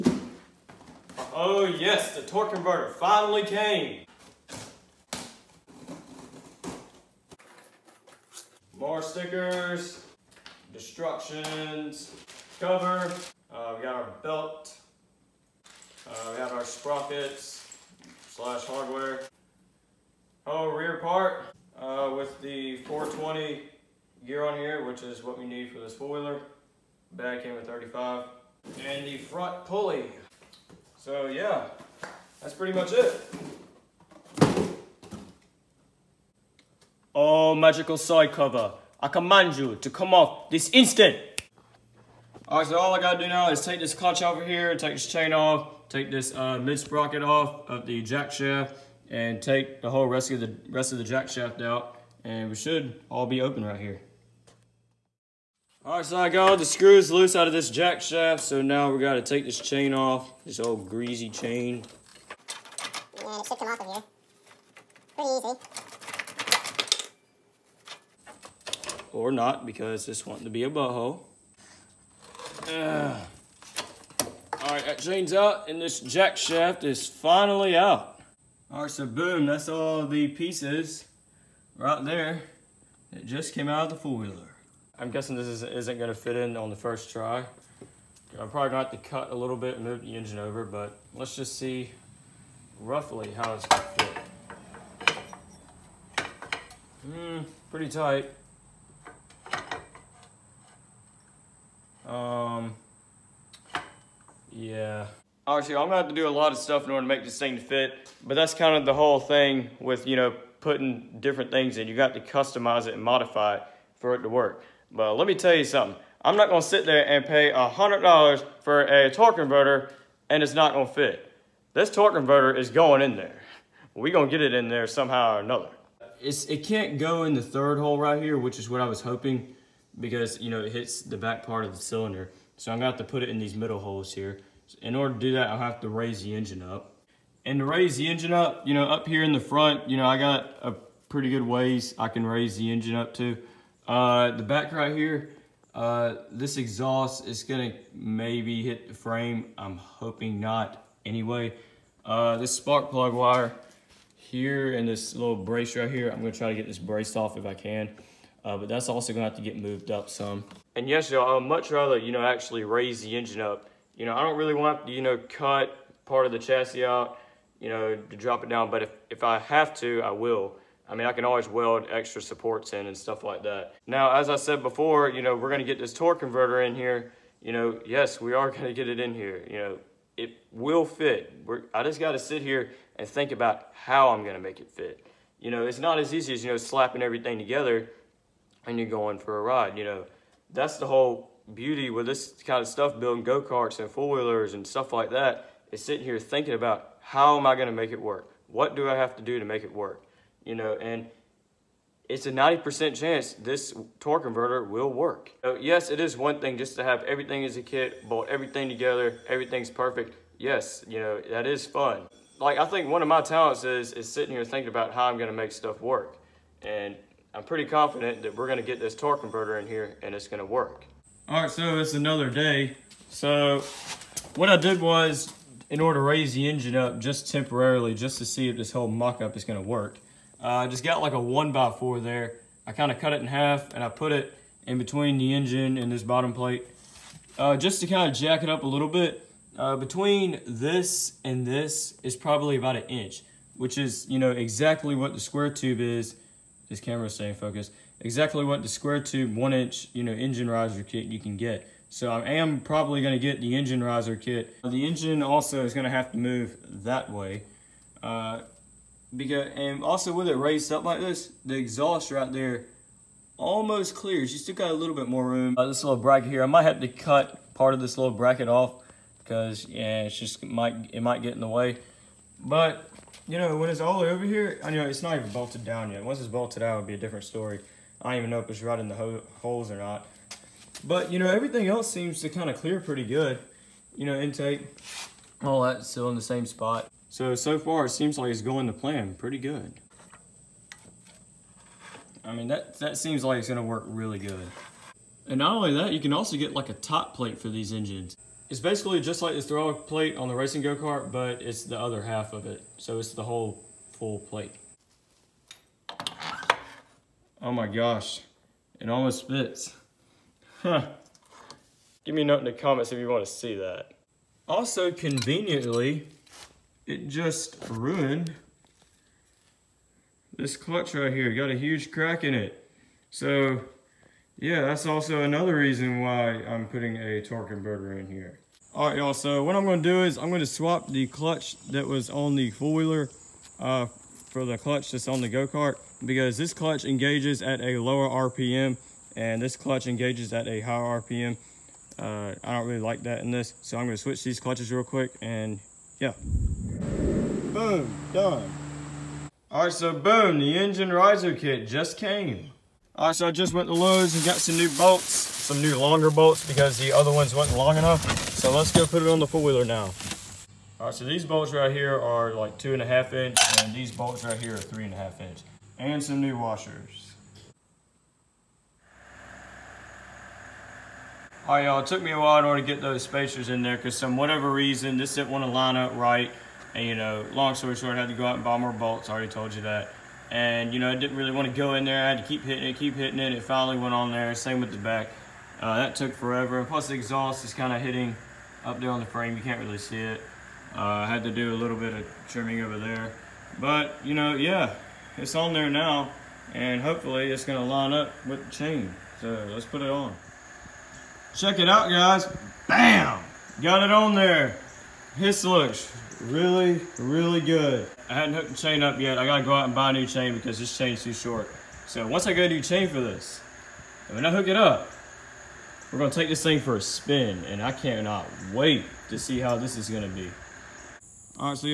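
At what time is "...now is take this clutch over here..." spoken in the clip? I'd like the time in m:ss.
0:43.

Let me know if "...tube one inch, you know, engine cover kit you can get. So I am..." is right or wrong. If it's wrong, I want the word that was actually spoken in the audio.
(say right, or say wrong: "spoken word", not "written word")
wrong: "riser", not "cover".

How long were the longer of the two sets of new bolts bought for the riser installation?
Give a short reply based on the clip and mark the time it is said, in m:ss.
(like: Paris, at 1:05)
3.5 inches, at 6:04.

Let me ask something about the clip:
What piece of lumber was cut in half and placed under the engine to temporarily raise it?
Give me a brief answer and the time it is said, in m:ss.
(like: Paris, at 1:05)
one by four, at 3:51.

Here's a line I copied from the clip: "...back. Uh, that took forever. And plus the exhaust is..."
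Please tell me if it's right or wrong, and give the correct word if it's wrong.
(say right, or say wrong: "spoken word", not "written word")
right.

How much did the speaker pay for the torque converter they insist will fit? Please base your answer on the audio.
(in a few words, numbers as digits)
$100.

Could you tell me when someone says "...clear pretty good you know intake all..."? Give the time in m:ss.
4:42.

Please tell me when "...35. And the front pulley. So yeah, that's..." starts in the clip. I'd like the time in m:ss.
0:27.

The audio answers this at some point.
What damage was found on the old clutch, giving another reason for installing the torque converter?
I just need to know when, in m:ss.
5:21.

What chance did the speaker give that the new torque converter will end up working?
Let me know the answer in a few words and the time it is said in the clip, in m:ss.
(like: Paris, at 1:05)
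90%, at 3:22.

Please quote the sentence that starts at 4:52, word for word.
I mean, that, that seems like it's gonna work really good.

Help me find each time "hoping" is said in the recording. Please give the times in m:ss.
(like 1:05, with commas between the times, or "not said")
2:09, 2:29.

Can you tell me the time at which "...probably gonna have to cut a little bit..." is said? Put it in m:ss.
1:28.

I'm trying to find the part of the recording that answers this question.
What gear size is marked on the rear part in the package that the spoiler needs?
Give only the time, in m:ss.
0:22.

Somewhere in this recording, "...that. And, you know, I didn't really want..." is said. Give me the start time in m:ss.
6:19.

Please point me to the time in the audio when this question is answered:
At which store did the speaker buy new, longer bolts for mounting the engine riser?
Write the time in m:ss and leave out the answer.
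5:53.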